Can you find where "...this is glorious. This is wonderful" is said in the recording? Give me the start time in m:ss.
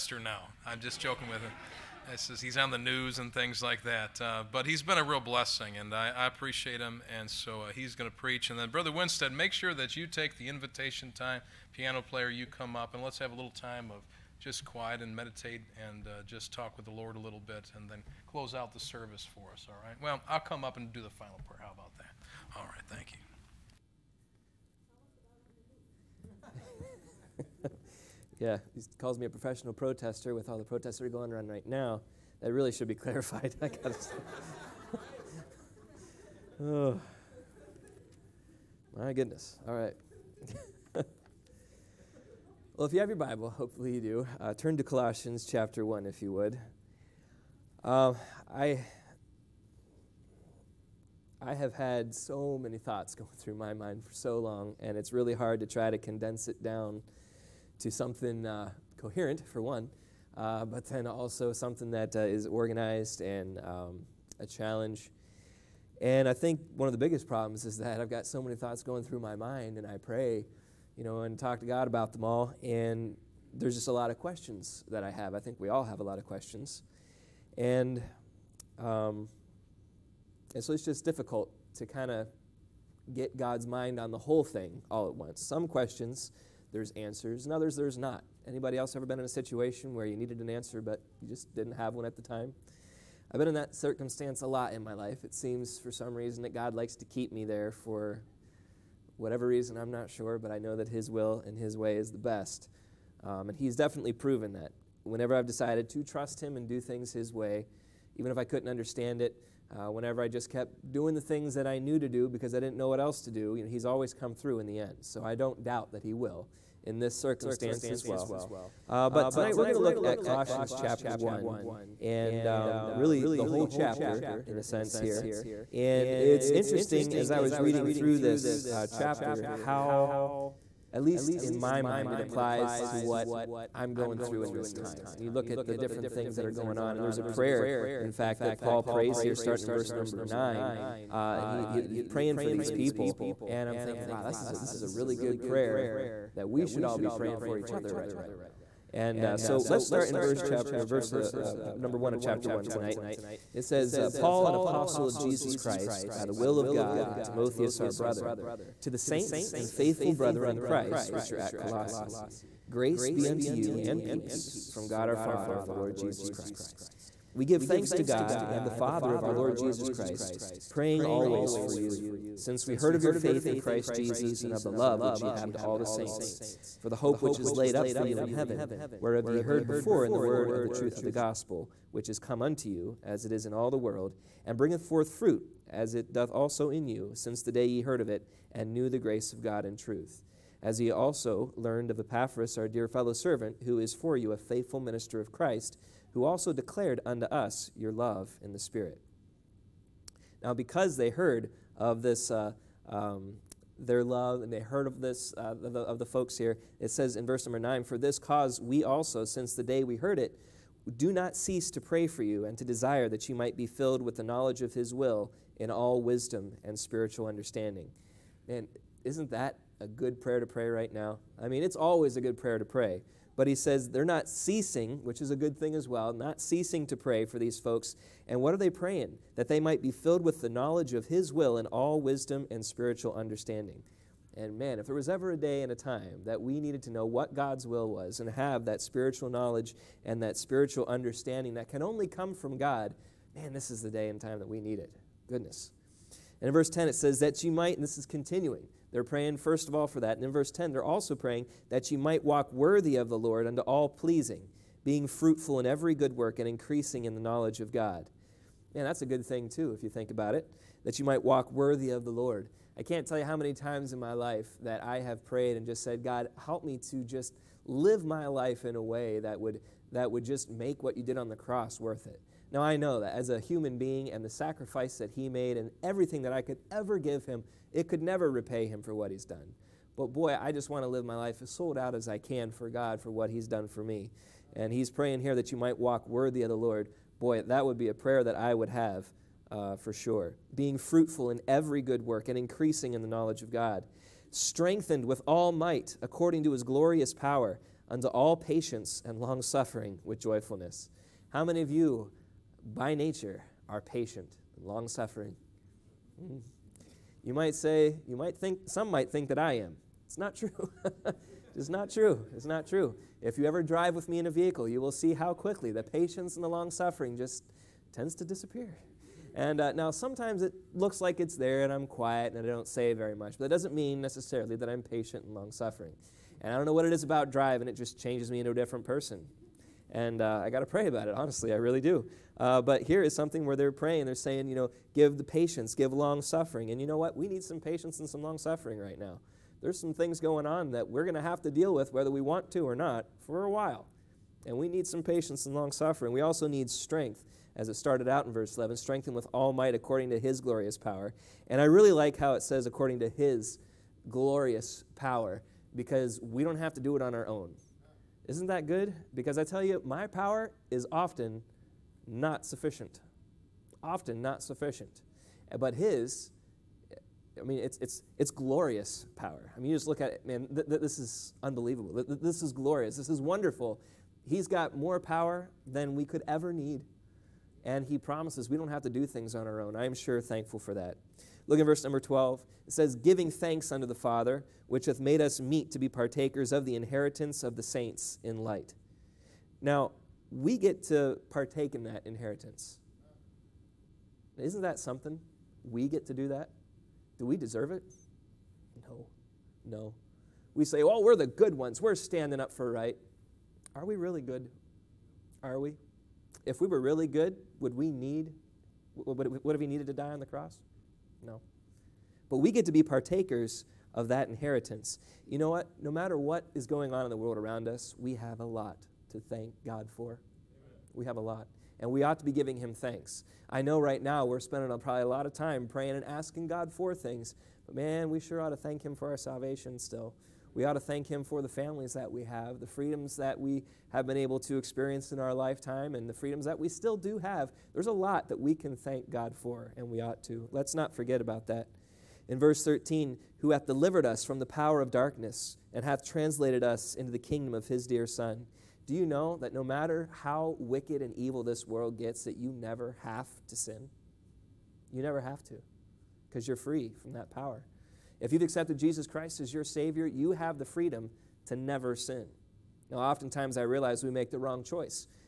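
6:12.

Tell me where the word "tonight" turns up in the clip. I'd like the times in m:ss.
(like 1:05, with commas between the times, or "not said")
1:59, 2:32.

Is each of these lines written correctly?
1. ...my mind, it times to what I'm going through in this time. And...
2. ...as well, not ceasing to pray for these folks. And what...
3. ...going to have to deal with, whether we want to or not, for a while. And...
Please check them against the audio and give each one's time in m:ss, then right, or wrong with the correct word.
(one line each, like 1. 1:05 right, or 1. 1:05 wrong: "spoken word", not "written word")
1. 2:11 wrong: "applies", not "times"
2. 3:45 right
3. 5:41 right.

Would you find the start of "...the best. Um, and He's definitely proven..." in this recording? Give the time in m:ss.
1:42.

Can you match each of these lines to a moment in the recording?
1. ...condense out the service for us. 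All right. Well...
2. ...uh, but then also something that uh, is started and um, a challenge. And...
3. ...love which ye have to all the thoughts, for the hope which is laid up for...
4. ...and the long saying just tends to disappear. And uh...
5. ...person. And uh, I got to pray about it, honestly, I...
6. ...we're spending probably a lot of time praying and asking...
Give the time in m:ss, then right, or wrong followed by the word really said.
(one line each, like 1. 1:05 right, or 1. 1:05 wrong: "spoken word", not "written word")
1. 0:18 wrong: "close", not "condense"
2. 1:00 wrong: "organized", not "started"
3. 2:54 wrong: "saints", not "thoughts"
4. 5:16 wrong: "suffering", not "saying"
5. 5:28 right
6. 7:04 right.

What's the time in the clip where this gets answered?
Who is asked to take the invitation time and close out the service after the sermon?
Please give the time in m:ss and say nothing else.
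0:08.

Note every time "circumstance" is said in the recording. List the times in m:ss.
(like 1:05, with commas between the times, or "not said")
1:33, 1:57.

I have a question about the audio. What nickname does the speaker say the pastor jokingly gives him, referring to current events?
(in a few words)
Professional protester.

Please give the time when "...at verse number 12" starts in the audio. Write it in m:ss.
6:21.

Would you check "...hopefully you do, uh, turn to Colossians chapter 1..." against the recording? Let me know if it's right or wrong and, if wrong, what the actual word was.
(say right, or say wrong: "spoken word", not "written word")
right.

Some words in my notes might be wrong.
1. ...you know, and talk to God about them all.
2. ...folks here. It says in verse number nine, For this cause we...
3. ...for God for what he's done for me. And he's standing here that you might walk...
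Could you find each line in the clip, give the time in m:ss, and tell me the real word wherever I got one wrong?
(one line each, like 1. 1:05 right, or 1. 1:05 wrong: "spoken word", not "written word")
1. 1:10 right
2. 3:26 right
3. 4:42 wrong: "praying", not "standing".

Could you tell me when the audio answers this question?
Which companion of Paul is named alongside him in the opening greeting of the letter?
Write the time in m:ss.
2:37.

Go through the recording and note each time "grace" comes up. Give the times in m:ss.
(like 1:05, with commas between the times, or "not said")
2:42, 3:08.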